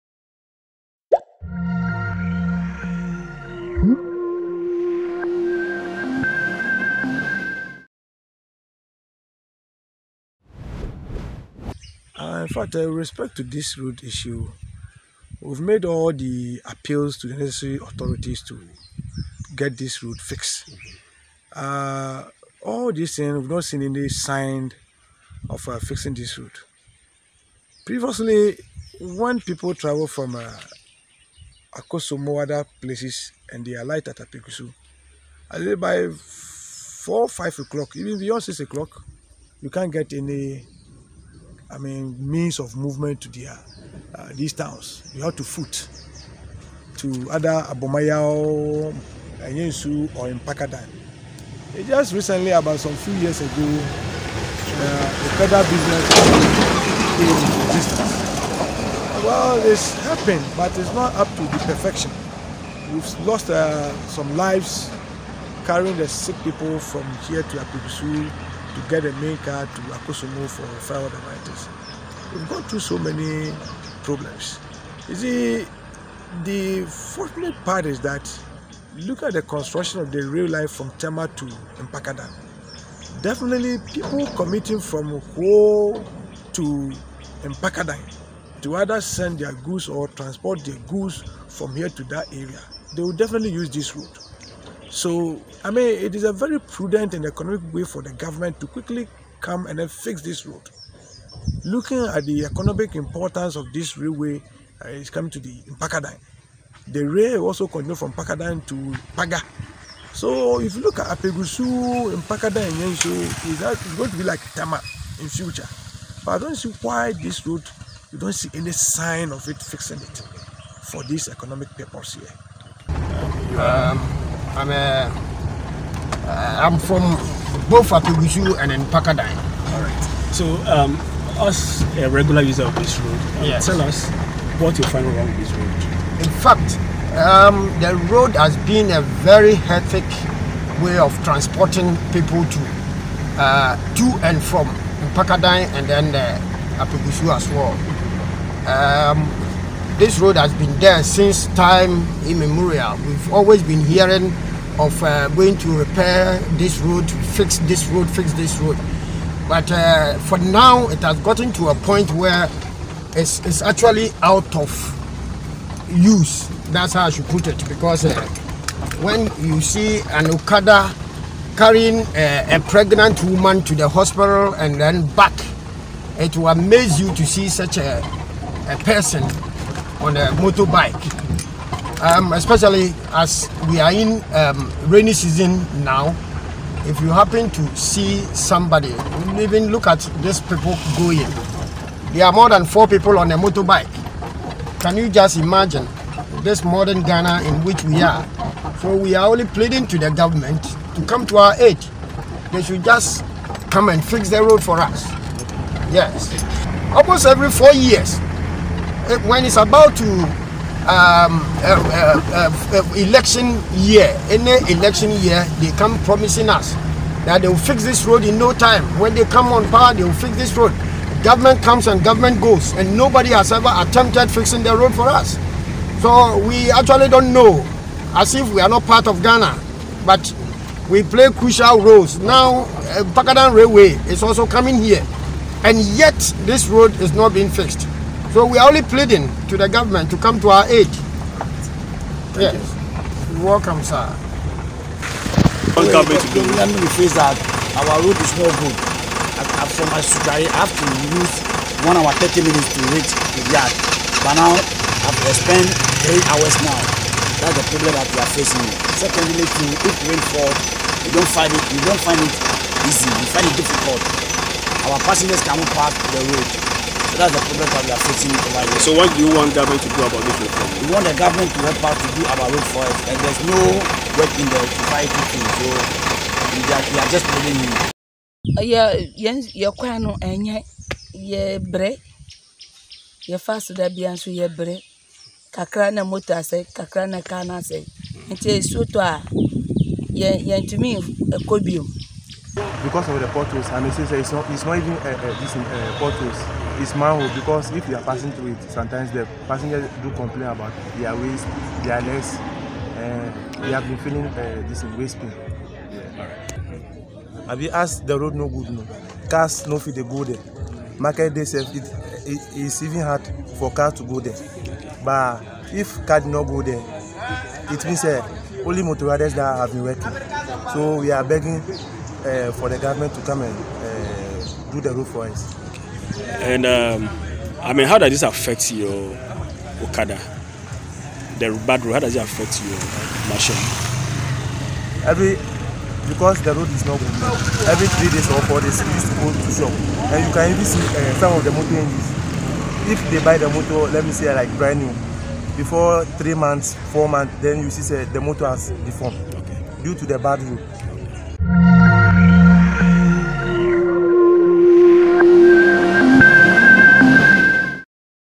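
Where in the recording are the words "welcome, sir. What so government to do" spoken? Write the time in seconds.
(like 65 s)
243 s.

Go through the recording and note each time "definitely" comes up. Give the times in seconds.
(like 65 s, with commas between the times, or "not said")
83 s, 93 s.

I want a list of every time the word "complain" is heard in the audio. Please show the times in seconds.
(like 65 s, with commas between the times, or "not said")
300 s.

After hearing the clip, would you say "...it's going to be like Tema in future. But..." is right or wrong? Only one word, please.
right.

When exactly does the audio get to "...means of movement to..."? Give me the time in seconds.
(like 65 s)
42 s.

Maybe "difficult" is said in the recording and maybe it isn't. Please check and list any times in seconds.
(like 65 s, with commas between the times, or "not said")
263 s.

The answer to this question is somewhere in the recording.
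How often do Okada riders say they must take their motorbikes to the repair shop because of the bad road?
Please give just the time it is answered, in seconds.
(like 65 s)
337 s.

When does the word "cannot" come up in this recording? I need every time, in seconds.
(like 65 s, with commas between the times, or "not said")
265 s.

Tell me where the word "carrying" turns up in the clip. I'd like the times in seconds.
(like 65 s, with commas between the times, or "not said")
65 s, 171 s.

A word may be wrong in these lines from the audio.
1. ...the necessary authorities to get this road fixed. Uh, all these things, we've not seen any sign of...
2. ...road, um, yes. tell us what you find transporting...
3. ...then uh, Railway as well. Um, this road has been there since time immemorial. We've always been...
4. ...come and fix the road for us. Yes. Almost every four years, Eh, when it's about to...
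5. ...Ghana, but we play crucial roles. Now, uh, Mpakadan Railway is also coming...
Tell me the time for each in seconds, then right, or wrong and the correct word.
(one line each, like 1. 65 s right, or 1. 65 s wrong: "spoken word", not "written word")
1. 17 s right
2. 132 s wrong: "wrong", not "transporting"
3. 145 s wrong: "Apegusu", not "Railway"
4. 203 s right
5. 229 s right.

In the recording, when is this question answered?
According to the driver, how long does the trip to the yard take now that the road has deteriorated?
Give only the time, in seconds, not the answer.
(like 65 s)
256 s.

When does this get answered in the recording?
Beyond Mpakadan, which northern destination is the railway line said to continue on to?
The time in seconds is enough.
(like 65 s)
109 s.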